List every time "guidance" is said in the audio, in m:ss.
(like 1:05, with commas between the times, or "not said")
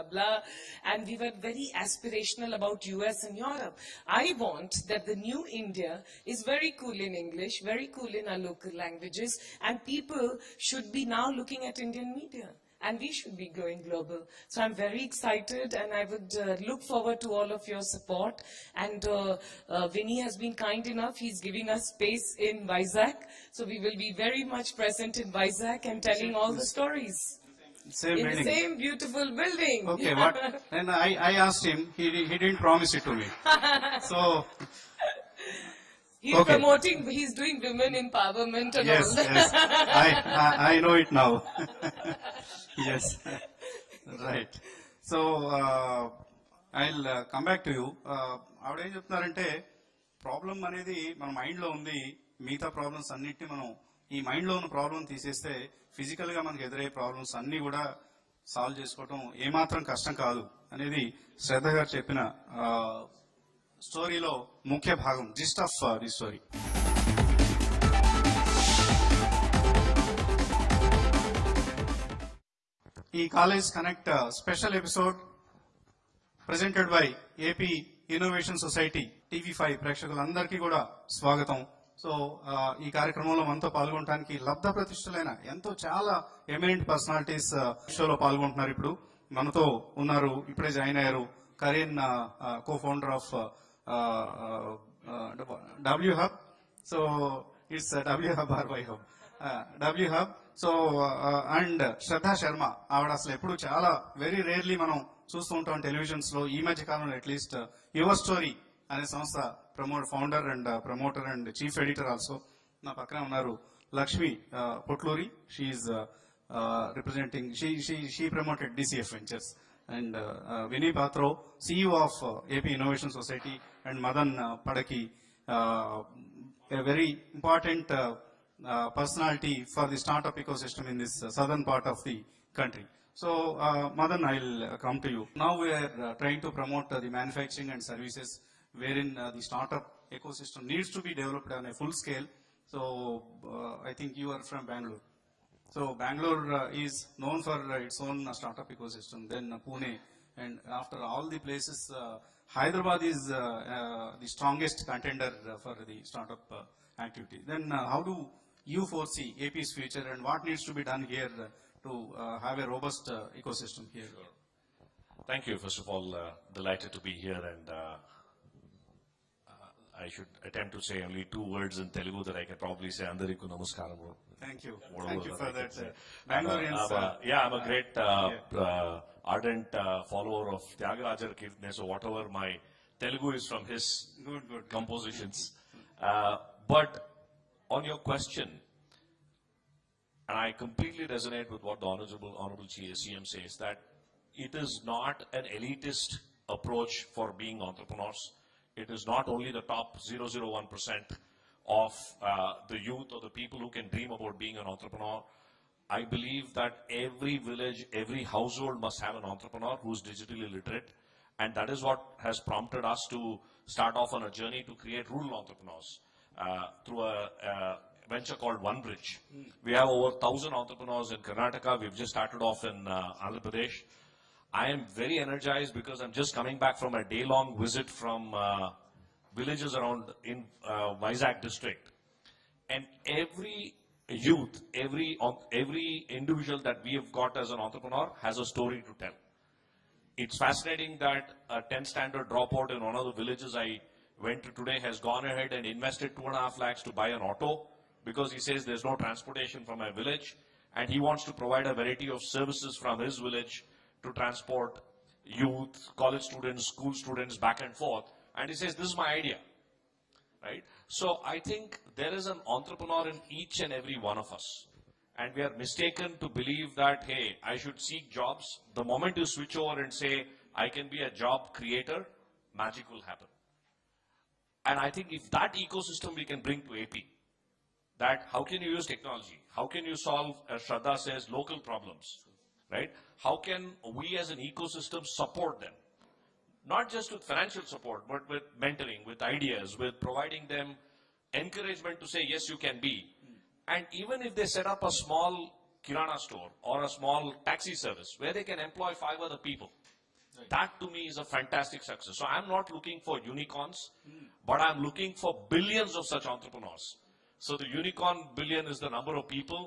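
not said.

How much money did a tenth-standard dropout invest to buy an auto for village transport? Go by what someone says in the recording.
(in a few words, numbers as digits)
2.5 lakhs.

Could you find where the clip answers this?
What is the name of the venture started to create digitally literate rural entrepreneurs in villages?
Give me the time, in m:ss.
3:38.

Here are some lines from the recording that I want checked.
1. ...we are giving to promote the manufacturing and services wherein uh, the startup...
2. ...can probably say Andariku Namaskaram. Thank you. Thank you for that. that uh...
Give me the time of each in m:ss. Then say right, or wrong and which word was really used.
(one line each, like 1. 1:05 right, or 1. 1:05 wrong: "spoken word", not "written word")
1. 2:15 wrong: "trying", not "giving"
2. 2:52 right.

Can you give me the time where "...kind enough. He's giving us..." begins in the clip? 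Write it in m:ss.
0:20.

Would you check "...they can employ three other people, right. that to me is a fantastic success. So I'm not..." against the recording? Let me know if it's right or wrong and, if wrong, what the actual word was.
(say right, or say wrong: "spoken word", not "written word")
wrong: "five", not "three".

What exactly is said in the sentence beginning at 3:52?
And every youth, every, every individual that we have got as an entrepreneur has a story to tell.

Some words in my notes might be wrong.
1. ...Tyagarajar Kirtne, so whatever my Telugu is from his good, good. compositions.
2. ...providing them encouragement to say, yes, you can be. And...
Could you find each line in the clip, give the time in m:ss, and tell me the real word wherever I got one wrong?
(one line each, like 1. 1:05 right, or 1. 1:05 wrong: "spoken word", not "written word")
1. 3:00 right
2. 4:50 right.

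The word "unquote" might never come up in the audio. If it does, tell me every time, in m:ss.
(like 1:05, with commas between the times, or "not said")
not said.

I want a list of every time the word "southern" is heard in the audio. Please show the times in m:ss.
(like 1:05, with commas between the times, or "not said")
2:11.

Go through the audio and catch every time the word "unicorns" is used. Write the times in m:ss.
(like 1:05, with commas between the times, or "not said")
5:03, 5:07.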